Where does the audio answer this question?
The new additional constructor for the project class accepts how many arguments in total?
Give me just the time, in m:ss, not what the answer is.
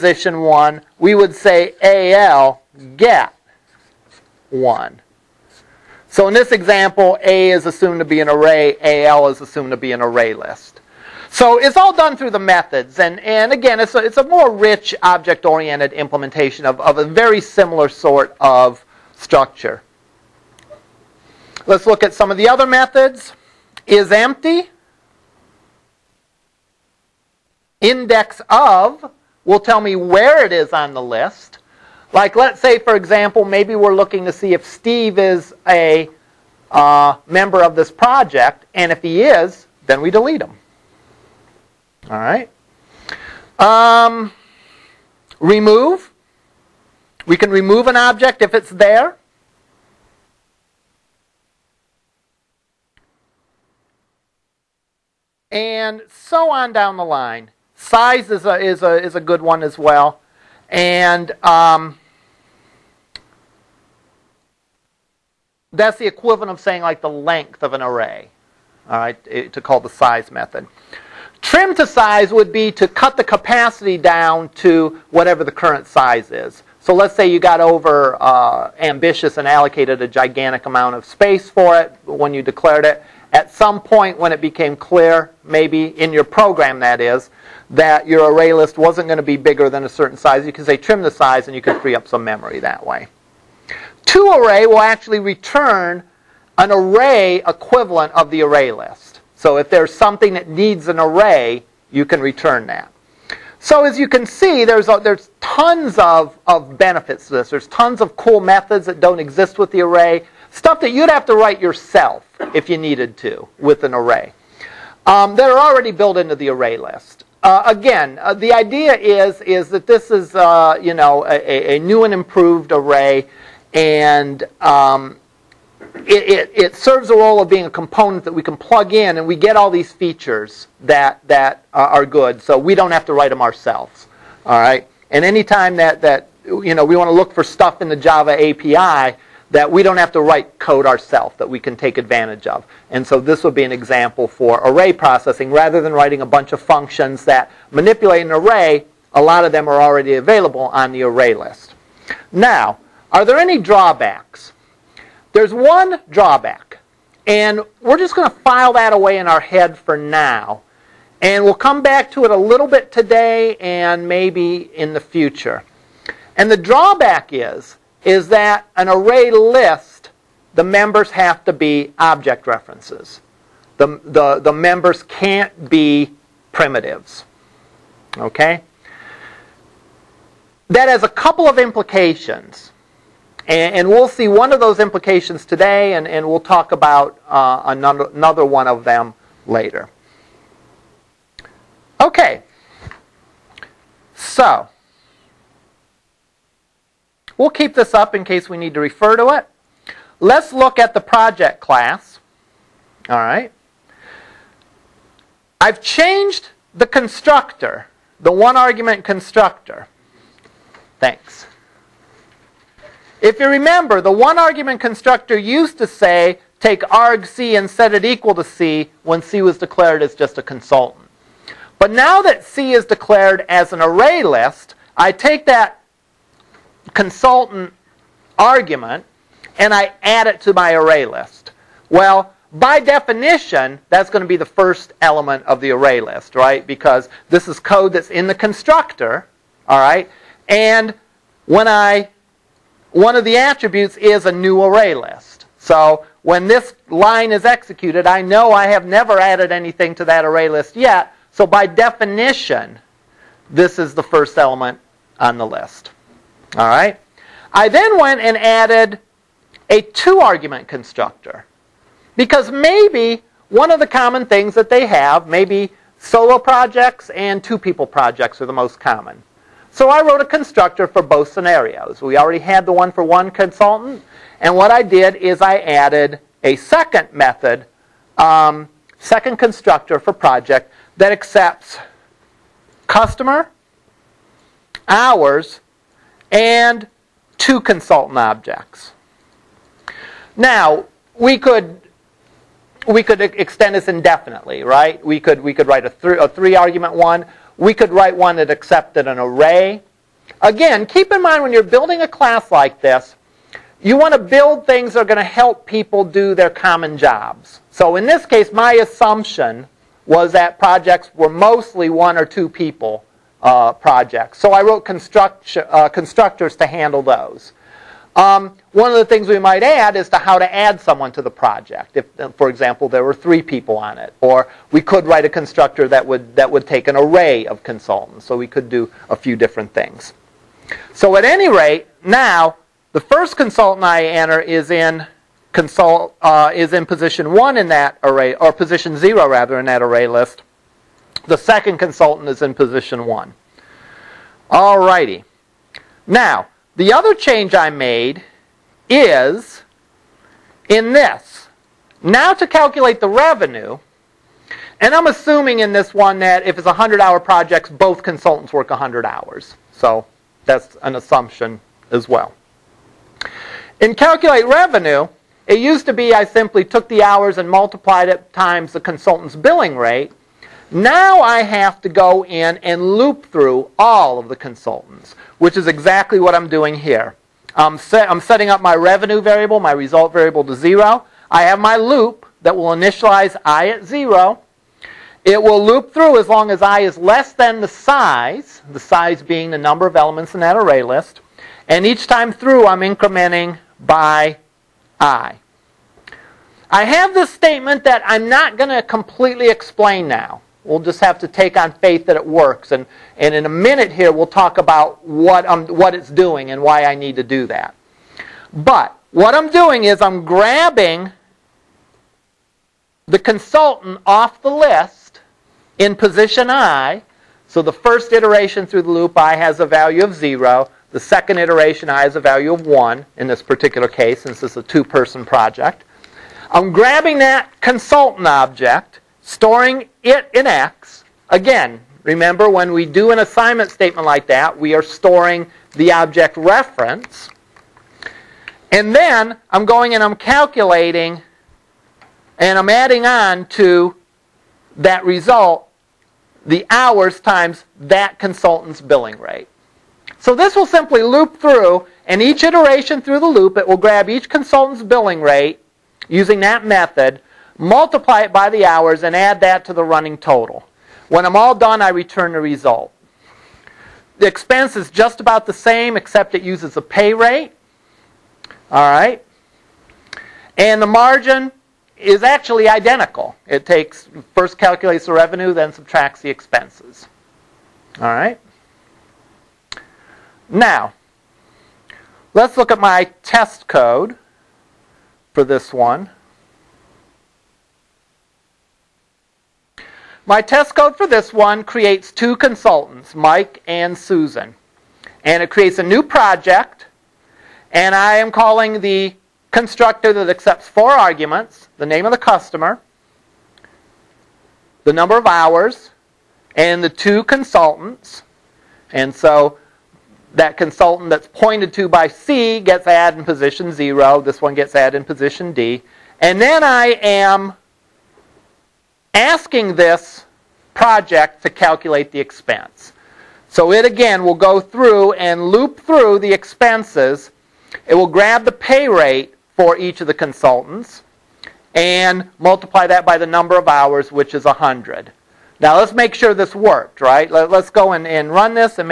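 8:20.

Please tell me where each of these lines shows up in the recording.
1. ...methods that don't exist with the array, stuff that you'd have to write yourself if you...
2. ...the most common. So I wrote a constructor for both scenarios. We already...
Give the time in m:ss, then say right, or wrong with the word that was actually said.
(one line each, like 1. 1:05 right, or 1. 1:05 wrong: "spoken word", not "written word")
1. 1:48 right
2. 4:28 right.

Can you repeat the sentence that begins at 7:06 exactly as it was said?
I'm grabbing that consultant object storing it in X.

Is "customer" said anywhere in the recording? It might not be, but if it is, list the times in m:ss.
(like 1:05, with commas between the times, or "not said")
4:42, 8:22.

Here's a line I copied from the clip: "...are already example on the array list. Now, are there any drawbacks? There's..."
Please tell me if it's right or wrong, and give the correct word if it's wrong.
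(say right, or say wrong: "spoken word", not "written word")
wrong: "available", not "example".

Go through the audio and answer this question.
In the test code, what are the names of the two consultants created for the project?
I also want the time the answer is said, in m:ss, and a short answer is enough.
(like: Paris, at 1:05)
Mike and Susan, at 8:13.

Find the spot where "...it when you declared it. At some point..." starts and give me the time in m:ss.
1:21.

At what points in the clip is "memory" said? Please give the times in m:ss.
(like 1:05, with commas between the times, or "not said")
1:32.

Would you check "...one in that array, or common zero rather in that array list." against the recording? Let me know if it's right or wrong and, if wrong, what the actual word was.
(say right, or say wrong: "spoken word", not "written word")
wrong: "position", not "common".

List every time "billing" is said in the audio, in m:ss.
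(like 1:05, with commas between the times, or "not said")
6:09, 7:28, 7:34.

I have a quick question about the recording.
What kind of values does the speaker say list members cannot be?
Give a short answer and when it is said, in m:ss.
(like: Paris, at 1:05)
primitives, at 2:56.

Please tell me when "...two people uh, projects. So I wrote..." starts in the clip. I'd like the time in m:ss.
5:12.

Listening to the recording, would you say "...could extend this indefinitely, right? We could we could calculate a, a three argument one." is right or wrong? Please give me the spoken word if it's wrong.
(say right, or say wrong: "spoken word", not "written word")
wrong: "write", not "calculate".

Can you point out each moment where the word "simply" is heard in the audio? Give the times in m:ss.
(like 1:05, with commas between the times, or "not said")
6:06, 7:30.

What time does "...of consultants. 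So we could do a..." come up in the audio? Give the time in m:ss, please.
5:27.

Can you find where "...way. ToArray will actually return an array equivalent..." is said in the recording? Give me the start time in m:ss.
1:32.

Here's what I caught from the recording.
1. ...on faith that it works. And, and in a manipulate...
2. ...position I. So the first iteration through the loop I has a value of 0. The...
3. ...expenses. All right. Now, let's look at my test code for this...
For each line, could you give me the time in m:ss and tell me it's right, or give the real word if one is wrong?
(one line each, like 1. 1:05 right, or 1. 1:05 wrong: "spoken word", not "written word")
1. 6:41 wrong: "minute", not "manipulate"
2. 6:55 right
3. 7:56 right.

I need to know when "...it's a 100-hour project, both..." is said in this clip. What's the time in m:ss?
5:56.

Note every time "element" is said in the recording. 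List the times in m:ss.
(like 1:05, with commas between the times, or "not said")
3:55, 4:14, 6:29.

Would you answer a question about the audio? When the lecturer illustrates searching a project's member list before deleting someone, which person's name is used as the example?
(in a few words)
Steve.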